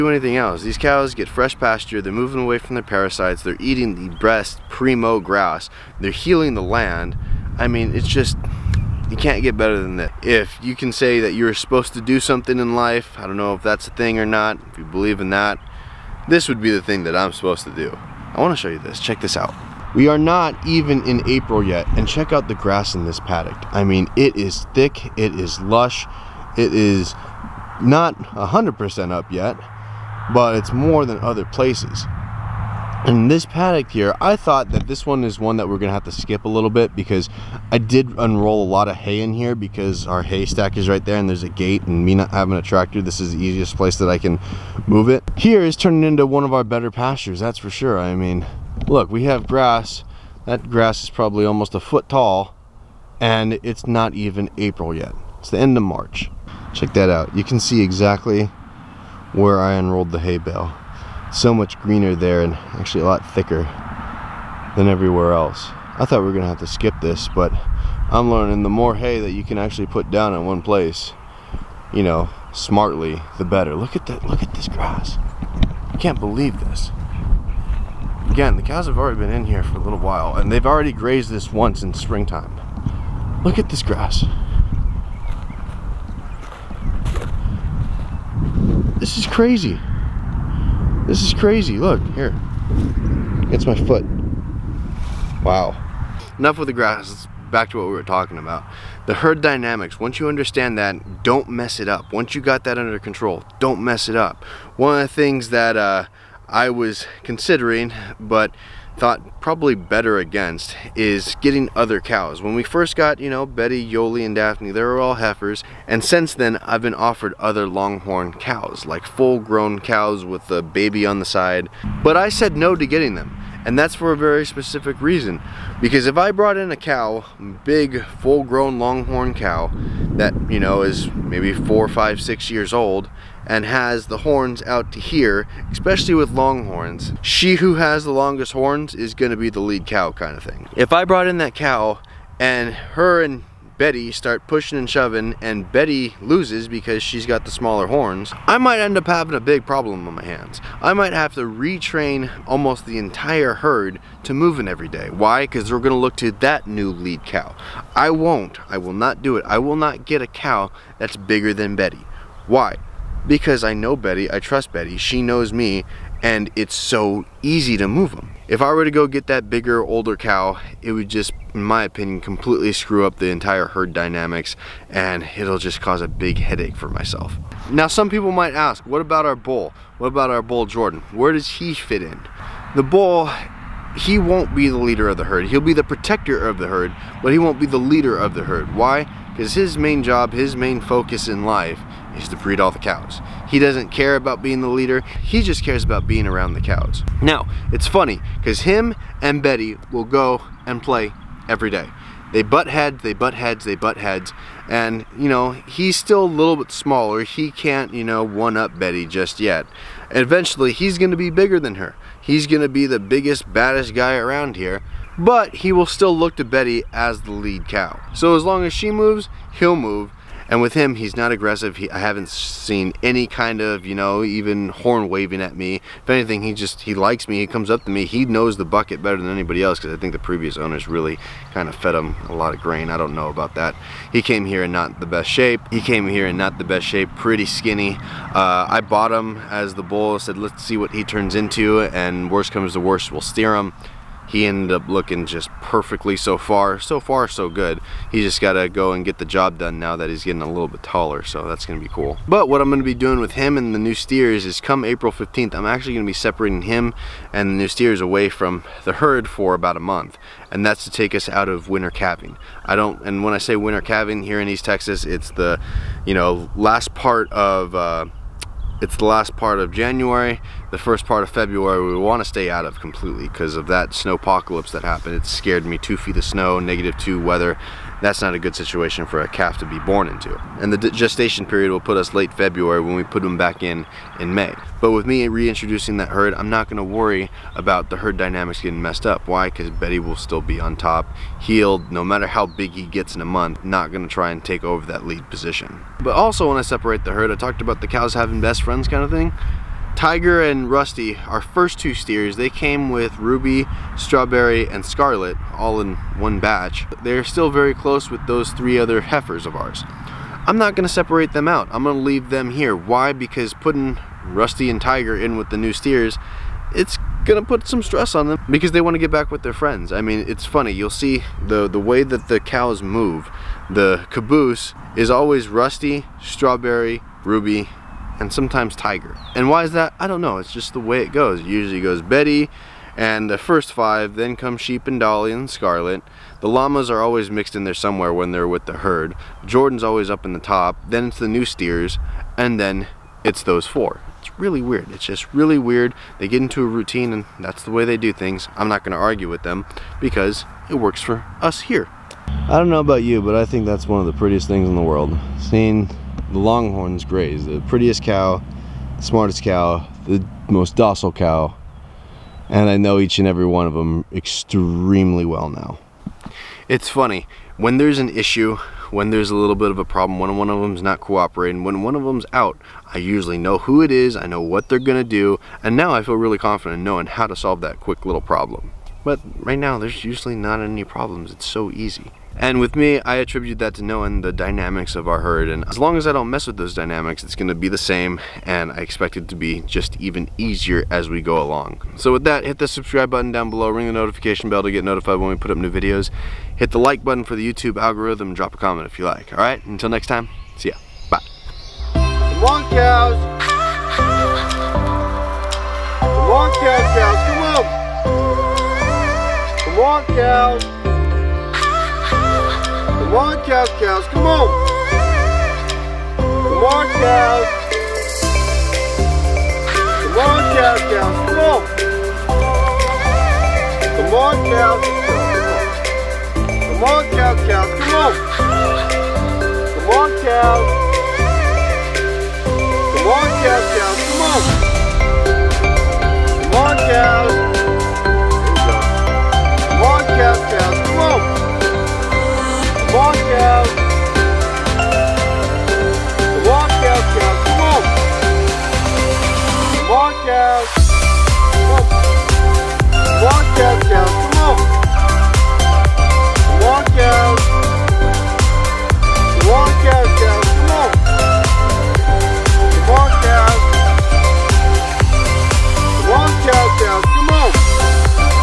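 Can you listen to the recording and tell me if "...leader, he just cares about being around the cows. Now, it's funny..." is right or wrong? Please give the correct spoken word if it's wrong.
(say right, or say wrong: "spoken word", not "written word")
right.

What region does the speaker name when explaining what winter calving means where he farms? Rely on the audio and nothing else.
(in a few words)
East Texas.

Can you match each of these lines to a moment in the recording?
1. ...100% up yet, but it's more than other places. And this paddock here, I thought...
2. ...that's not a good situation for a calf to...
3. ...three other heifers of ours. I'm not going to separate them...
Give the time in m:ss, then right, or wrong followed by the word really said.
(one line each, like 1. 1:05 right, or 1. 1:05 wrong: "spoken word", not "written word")
1. 0:28 right
2. 4:38 right
3. 5:08 right.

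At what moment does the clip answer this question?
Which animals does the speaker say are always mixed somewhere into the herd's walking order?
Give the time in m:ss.
5:36.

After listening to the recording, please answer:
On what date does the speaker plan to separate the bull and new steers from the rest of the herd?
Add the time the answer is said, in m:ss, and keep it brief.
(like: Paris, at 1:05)
April 15th, at 4:14.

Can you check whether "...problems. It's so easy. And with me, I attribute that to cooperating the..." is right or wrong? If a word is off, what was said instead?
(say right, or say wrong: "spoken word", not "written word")
wrong: "knowing", not "cooperating".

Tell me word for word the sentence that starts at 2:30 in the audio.
I might have to retrain almost the entire herd to moving every day.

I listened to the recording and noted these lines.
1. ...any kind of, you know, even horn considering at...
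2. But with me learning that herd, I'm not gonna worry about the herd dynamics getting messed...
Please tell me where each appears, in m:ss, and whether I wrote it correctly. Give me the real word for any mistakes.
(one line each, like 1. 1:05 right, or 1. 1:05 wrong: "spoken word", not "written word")
1. 3:43 wrong: "waving", not "considering"
2. 4:44 wrong: "reintroducing", not "learning".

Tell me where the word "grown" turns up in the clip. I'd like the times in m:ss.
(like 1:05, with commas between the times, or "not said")
1:59, 2:08.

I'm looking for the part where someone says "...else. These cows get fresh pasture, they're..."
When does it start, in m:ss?
0:00.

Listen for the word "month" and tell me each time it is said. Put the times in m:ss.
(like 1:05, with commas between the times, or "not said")
4:19, 4:53.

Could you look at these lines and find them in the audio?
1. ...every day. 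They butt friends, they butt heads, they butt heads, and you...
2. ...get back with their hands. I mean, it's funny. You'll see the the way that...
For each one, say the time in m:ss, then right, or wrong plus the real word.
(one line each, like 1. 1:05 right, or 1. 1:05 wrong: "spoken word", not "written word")
1. 3:21 wrong: "heads", not "friends"
2. 5:18 wrong: "friends", not "hands".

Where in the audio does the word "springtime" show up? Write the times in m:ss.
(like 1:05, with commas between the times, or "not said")
1:21.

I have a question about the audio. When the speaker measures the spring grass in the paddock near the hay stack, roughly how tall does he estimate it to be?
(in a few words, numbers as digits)
almost a foot.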